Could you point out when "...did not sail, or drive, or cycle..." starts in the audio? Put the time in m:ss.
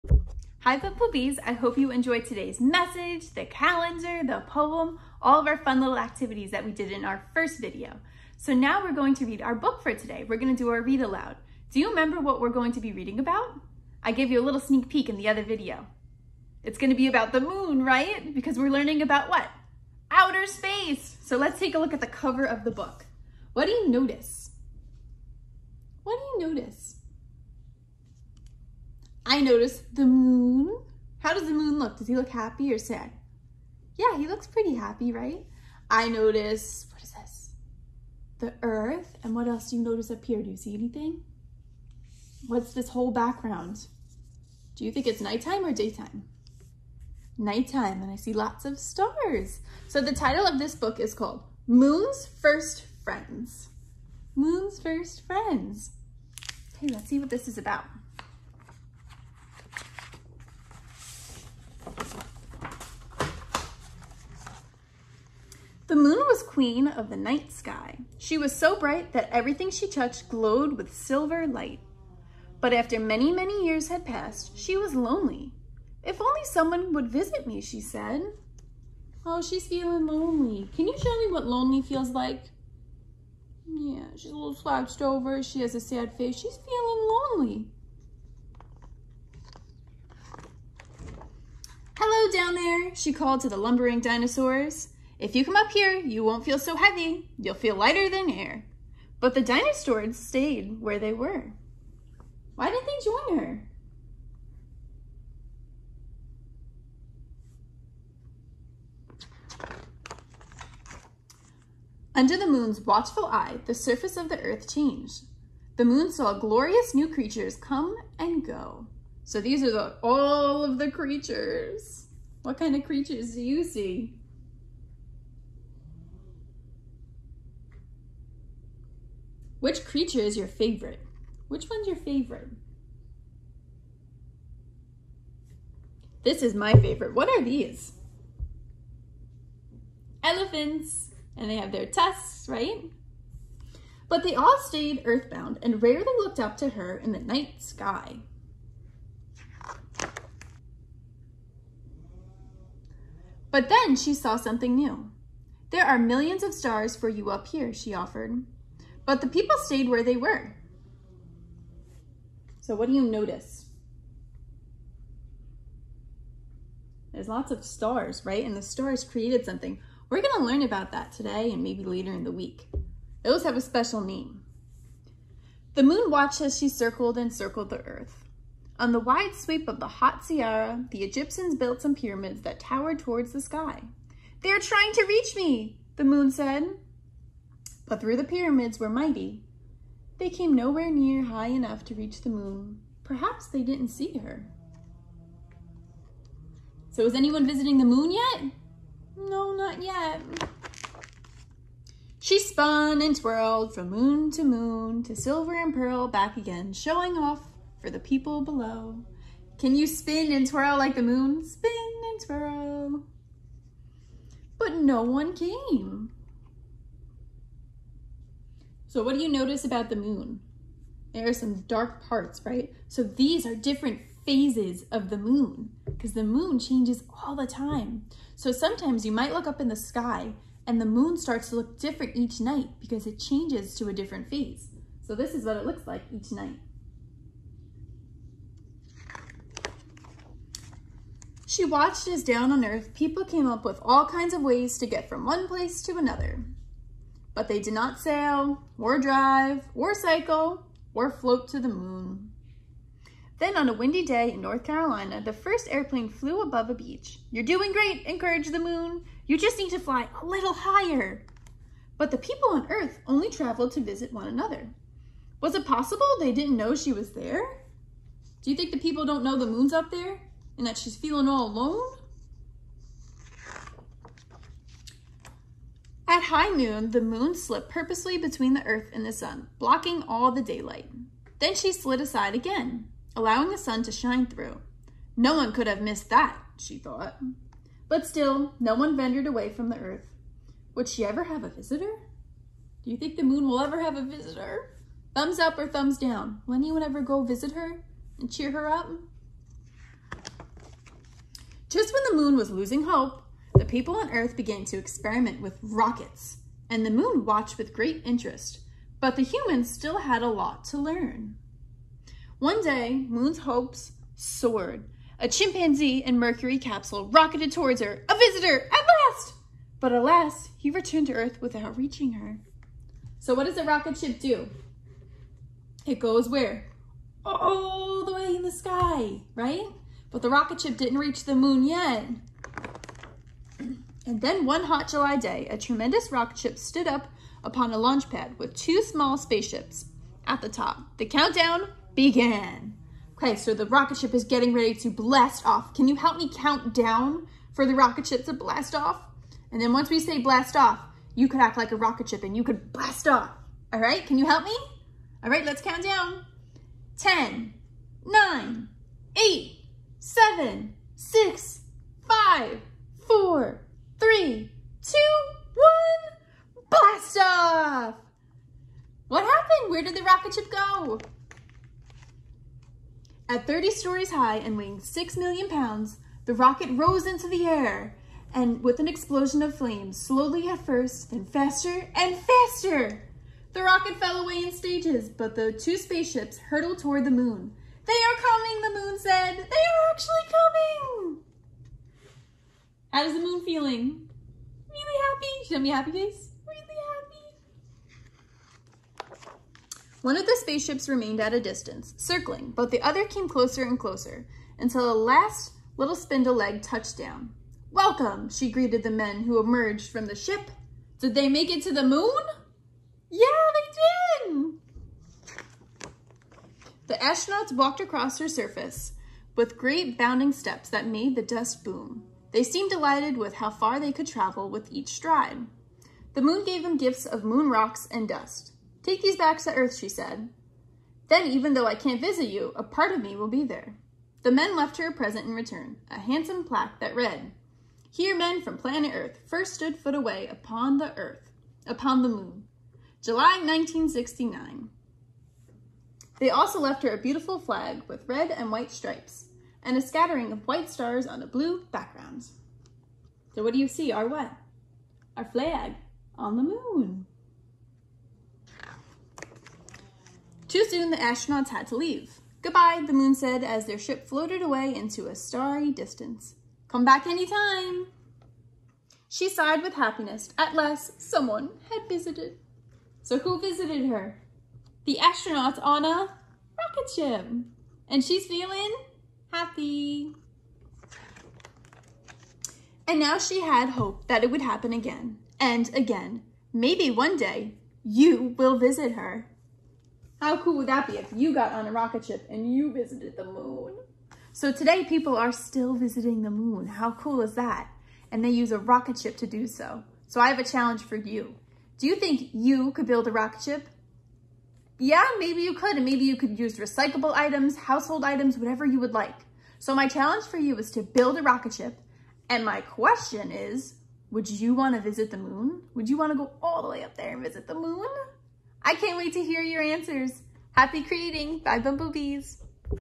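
4:07.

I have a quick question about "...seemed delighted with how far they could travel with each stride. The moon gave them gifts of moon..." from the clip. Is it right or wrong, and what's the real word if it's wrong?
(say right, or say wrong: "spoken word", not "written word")
right.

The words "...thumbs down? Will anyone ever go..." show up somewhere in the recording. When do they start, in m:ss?
4:55.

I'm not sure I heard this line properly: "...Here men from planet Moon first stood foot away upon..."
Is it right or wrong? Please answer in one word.
wrong.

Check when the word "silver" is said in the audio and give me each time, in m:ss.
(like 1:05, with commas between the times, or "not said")
1:10, 3:25.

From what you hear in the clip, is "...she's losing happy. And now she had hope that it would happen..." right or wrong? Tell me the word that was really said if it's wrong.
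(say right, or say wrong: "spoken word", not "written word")
wrong: "feeling", not "losing".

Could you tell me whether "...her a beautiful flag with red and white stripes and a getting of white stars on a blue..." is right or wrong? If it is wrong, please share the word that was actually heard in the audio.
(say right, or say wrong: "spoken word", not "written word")
wrong: "scattering", not "getting".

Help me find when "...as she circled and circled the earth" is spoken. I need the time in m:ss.
2:56.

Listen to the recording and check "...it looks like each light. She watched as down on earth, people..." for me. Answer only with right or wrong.
wrong.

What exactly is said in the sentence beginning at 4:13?
Then on a windy day in North Carolina, the first airplane flew above a beach.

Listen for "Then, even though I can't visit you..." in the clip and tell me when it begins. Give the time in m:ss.
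7:11.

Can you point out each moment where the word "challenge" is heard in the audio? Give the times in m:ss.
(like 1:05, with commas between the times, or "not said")
8:20, 8:29.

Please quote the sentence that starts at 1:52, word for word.
Under the moon's watchful eye, the surface of the earth changed.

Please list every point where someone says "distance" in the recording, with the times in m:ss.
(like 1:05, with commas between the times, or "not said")
6:41, 7:45.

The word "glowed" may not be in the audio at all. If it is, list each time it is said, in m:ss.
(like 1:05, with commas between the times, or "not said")
1:10.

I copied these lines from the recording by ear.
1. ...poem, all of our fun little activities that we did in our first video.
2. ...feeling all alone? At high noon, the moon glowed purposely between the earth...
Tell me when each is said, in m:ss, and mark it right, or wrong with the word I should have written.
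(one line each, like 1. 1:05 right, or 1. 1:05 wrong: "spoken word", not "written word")
1. 0:04 right
2. 4:30 wrong: "slipped", not "glowed".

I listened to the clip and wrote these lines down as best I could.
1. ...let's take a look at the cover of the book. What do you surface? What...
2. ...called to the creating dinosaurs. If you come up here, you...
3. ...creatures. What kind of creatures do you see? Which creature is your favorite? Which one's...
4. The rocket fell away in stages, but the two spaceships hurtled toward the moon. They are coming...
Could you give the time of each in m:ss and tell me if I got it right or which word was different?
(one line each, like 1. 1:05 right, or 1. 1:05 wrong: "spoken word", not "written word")
1. 0:21 wrong: "notice", not "surface"
2. 1:33 wrong: "lumbering", not "creating"
3. 2:00 right
4. 6:23 right.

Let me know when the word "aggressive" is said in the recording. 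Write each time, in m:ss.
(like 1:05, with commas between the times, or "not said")
not said.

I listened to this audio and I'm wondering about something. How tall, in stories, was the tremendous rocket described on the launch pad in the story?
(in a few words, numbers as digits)
30 stories.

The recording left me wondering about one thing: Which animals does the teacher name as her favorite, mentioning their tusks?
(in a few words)
Elephants.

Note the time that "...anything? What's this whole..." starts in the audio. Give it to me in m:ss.
0:40.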